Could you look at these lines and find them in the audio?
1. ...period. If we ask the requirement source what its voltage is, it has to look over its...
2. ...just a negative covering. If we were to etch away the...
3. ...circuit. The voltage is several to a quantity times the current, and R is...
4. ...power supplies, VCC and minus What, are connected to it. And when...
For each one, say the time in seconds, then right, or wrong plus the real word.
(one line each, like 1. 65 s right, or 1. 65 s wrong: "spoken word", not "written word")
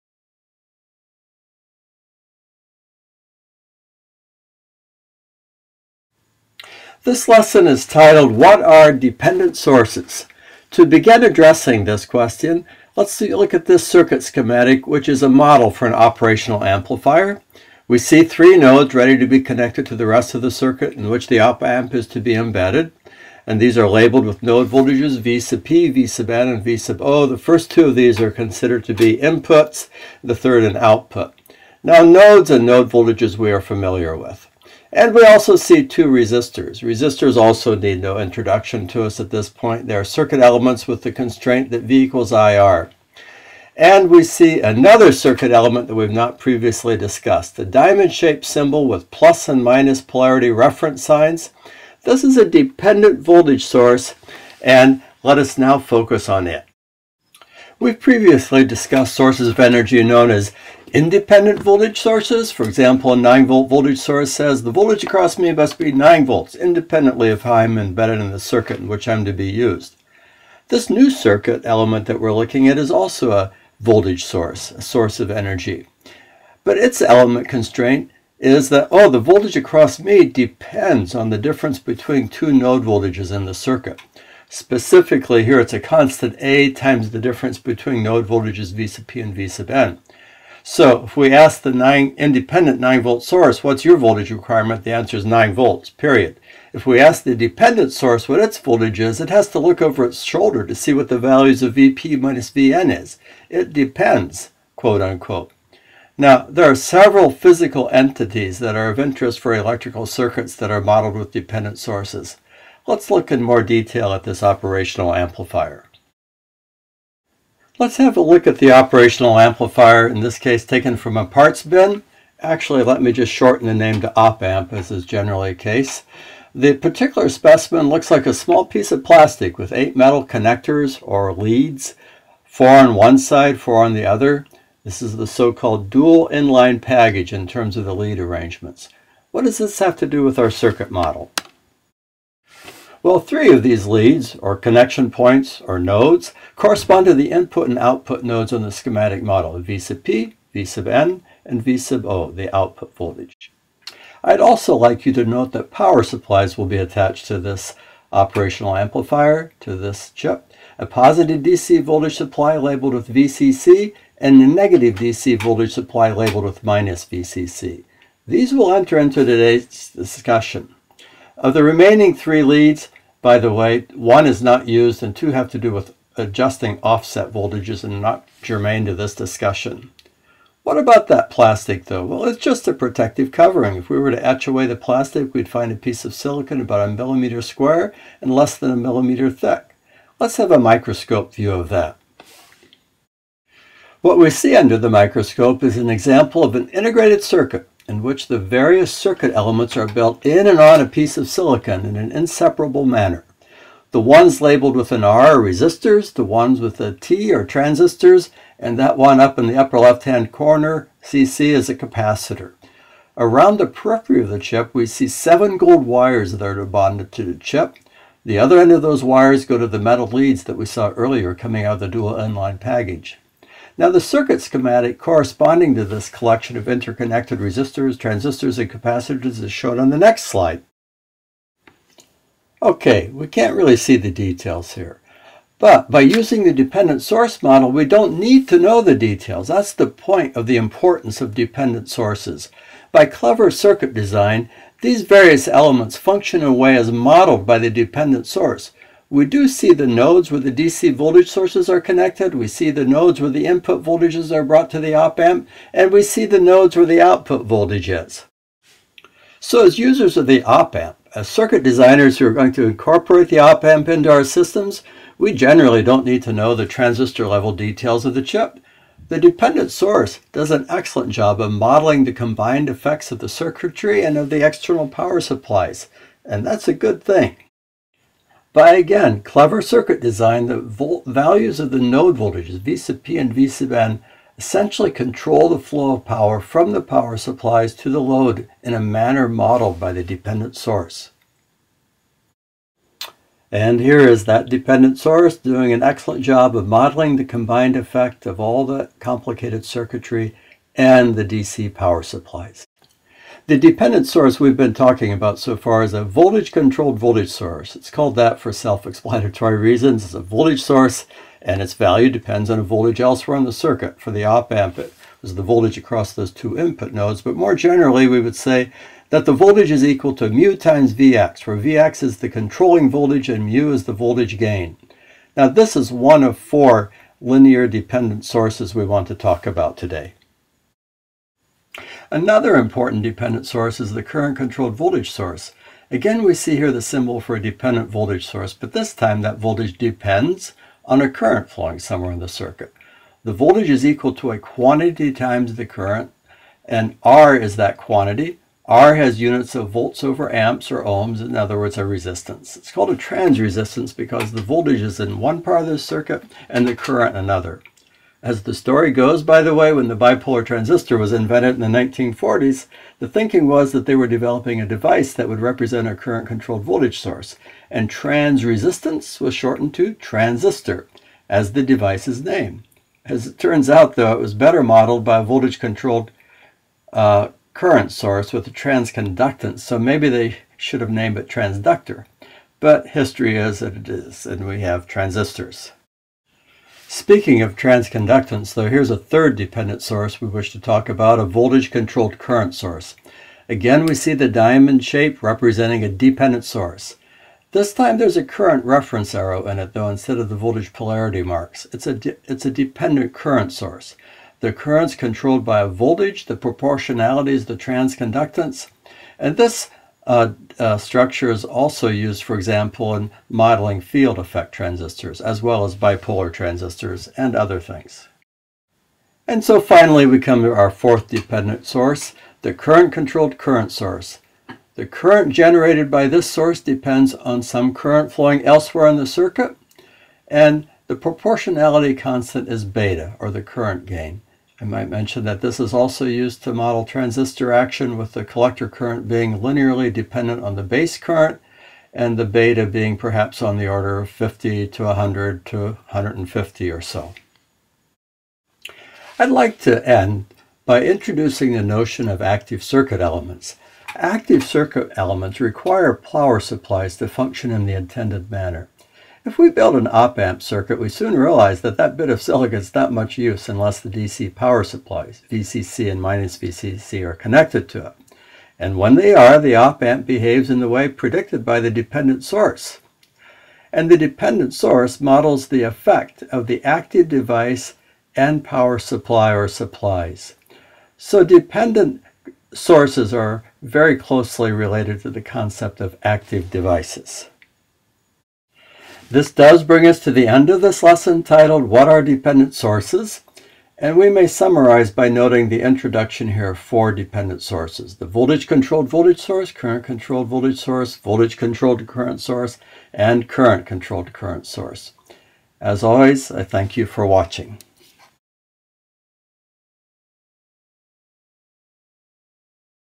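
1. 95 s wrong: "dependent", not "requirement"
2. 182 s wrong: "protective", not "negative"
3. 342 s wrong: "equal", not "several"
4. 464 s wrong: "VCC", not "What".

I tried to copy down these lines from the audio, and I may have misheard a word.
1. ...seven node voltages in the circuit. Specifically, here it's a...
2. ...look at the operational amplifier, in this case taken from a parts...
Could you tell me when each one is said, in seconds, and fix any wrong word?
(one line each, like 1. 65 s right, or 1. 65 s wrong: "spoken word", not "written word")
1. 82 s wrong: "two", not "seven"
2. 118 s right.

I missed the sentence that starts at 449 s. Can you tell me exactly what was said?
I'd like to end by introducing the notion of active circuit elements.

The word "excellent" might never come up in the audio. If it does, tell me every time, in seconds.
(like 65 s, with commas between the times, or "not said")
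270 s, 295 s.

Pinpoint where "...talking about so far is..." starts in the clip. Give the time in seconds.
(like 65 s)
304 s.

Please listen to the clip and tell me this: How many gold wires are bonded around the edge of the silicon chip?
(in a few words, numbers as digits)
7.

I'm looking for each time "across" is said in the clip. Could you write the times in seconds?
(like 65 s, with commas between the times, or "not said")
65 s, 79 s, 315 s.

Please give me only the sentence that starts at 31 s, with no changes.
Now nodes and node voltages we are familiar with.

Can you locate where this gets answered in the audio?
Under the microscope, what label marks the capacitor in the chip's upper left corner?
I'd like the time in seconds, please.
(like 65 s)
211 s.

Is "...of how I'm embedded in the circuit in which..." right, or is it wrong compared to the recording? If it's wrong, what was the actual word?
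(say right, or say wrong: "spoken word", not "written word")
right.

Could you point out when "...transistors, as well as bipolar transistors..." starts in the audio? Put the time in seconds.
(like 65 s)
414 s.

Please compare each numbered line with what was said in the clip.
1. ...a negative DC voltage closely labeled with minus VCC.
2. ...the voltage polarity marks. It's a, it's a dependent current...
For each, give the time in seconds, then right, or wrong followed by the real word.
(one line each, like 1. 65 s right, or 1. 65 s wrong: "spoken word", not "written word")
1. 164 s wrong: "supply", not "closely"
2. 400 s right.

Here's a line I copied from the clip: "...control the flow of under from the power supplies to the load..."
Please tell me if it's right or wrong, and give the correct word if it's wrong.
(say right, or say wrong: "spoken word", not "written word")
wrong: "power", not "under".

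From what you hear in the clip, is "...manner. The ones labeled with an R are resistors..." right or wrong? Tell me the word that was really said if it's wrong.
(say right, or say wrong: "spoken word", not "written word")
right.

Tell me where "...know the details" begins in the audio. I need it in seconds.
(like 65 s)
238 s.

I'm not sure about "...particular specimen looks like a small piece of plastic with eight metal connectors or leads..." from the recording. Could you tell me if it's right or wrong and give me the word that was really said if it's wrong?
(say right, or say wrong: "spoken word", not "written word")
right.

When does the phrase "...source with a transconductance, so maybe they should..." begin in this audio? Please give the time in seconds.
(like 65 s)
377 s.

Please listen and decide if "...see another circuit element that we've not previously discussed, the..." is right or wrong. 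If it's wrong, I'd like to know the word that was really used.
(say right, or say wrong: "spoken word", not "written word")
right.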